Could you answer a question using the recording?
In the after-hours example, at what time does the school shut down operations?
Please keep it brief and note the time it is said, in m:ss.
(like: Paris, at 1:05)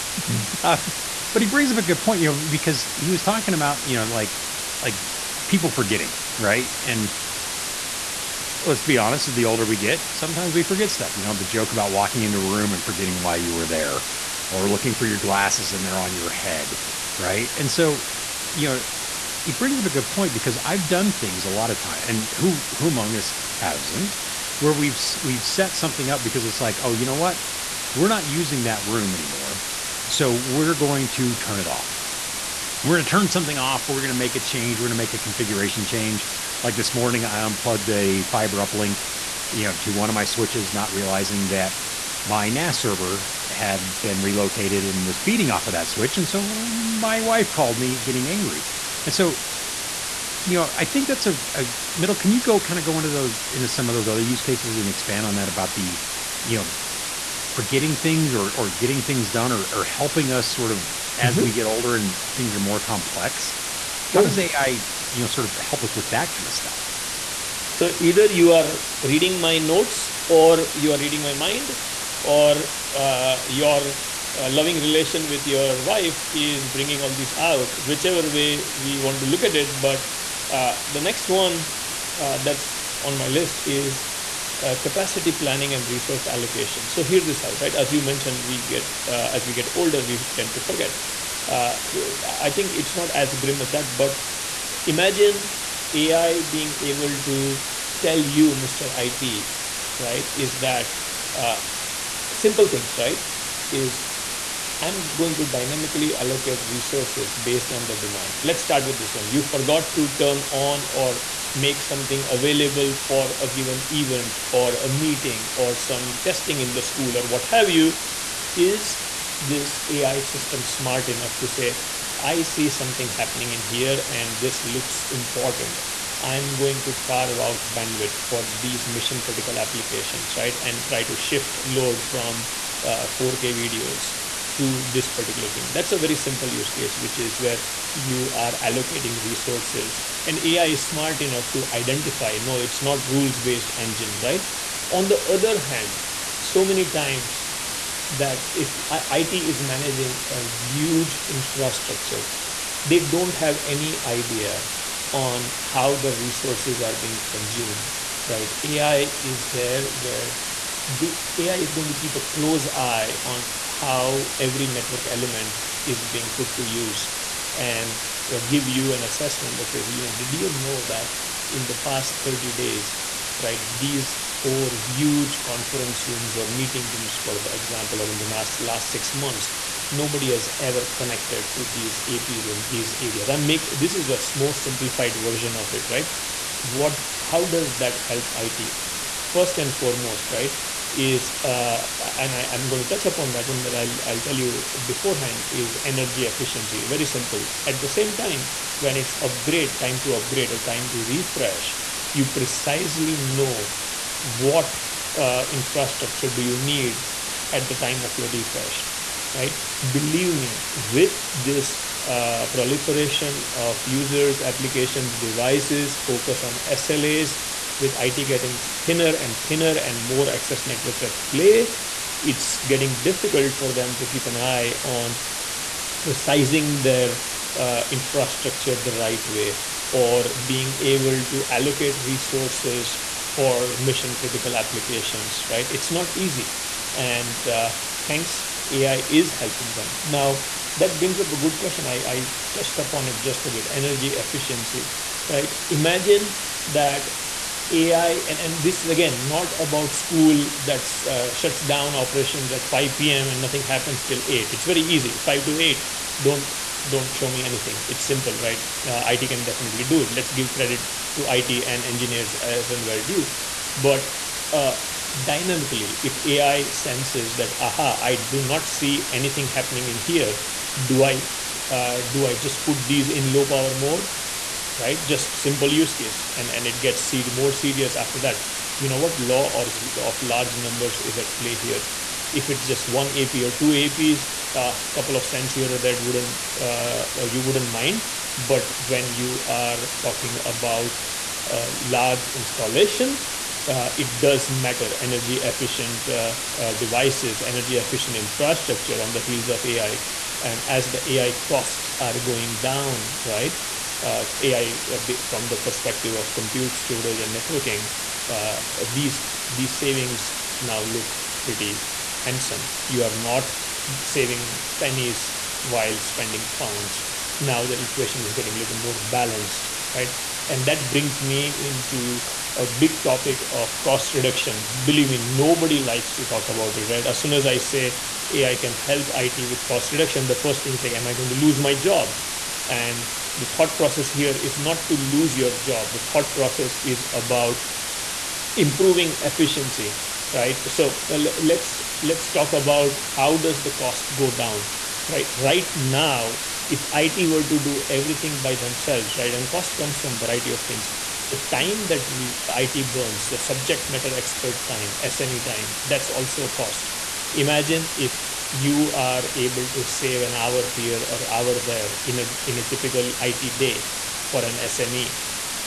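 5 p.m., at 4:12.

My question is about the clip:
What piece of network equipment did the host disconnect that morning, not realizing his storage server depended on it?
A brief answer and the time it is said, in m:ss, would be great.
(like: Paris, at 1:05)
fiber uplink, at 0:38.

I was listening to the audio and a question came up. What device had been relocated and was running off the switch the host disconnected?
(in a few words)
NAS server.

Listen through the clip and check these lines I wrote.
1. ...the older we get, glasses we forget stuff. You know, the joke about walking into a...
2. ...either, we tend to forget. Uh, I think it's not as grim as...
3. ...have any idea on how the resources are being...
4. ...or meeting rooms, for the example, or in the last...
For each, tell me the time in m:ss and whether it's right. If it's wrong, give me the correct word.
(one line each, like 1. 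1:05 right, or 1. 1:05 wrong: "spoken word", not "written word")
1. 0:09 wrong: "sometimes", not "glasses"
2. 1:29 wrong: "older", not "either"
3. 2:33 right
4. 2:56 right.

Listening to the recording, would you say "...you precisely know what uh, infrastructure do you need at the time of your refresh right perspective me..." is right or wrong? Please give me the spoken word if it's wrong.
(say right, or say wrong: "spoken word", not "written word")
wrong: "believe", not "perspective".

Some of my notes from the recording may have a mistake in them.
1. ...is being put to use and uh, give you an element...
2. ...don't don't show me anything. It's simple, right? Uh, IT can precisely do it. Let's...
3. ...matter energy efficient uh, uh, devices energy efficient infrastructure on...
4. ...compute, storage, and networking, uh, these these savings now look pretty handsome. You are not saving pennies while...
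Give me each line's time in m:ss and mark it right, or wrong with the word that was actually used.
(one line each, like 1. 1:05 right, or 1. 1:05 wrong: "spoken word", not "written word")
1. 2:45 wrong: "assessment", not "element"
2. 4:16 wrong: "definitely", not "precisely"
3. 4:54 right
4. 5:06 right.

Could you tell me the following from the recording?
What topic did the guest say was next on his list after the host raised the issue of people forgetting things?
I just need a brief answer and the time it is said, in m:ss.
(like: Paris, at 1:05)
capacity planning, at 1:24.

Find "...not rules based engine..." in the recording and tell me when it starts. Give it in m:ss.
2:22.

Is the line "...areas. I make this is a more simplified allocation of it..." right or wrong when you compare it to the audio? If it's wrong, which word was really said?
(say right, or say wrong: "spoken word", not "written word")
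wrong: "version", not "allocation".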